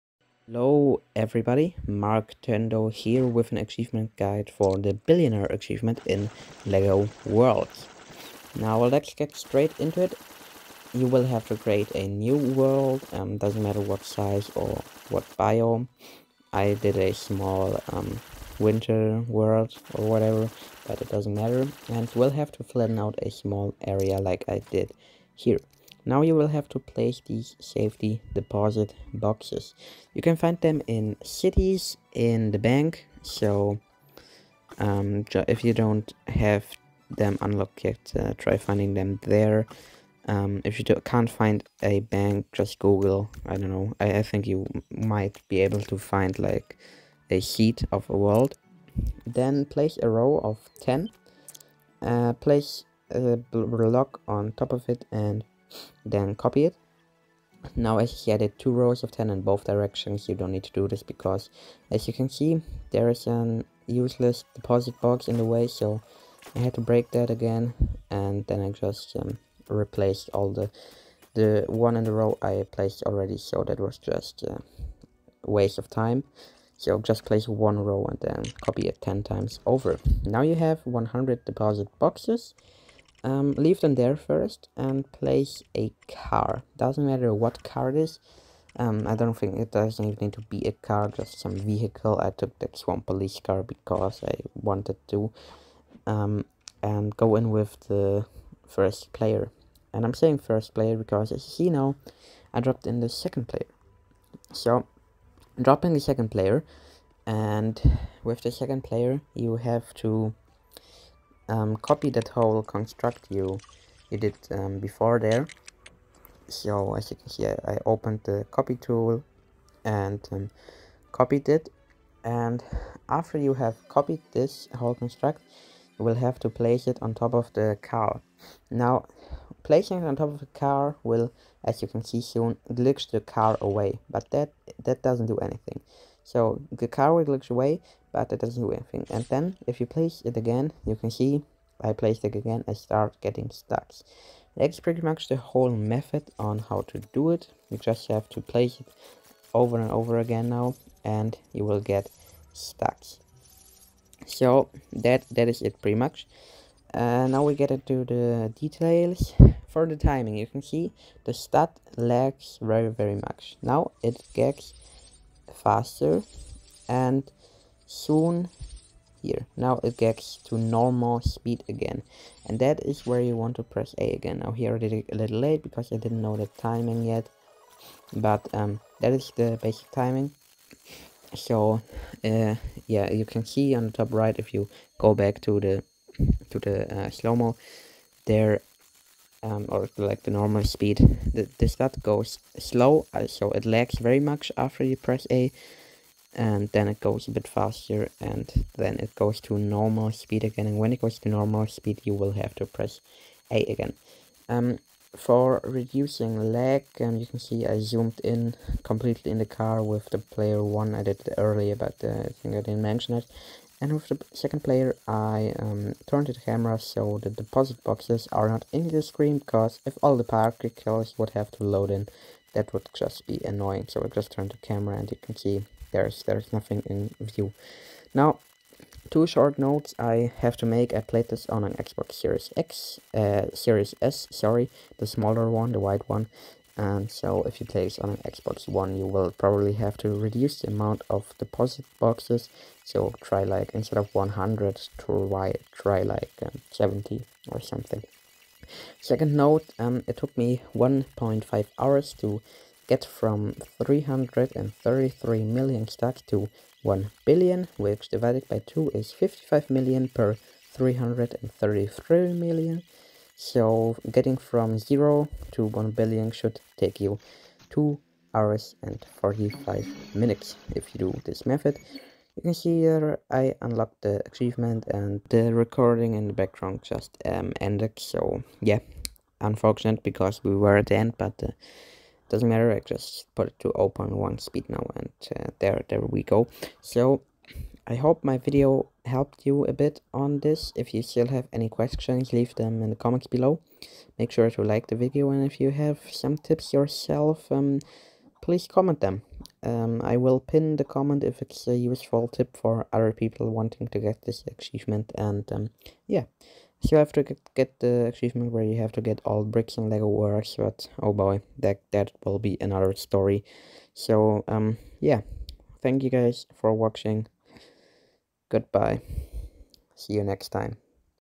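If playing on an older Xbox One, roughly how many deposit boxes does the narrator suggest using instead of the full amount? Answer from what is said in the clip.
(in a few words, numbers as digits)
70.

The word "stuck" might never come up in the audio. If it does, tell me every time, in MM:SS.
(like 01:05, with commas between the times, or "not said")
02:23, 02:32.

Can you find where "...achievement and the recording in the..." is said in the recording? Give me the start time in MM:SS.
04:34.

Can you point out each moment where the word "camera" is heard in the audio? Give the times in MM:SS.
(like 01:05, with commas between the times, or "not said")
03:36, 03:44.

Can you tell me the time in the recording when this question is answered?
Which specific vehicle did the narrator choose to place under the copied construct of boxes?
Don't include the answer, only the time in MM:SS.
01:32.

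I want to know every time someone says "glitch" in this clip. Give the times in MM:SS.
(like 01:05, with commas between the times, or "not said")
02:12, 02:17.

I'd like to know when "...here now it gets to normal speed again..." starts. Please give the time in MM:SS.
02:49.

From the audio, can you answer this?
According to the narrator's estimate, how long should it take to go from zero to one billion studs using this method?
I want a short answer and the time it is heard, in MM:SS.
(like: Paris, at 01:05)
2 hours and 45 minutes, at 04:27.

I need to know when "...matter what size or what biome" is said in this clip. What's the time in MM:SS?
00:13.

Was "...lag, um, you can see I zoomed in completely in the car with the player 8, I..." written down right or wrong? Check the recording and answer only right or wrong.
wrong.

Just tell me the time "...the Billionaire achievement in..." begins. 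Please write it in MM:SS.
00:04.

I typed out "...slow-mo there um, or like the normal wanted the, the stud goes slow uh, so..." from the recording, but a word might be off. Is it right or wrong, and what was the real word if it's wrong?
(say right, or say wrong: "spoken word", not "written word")
wrong: "speed", not "wanted".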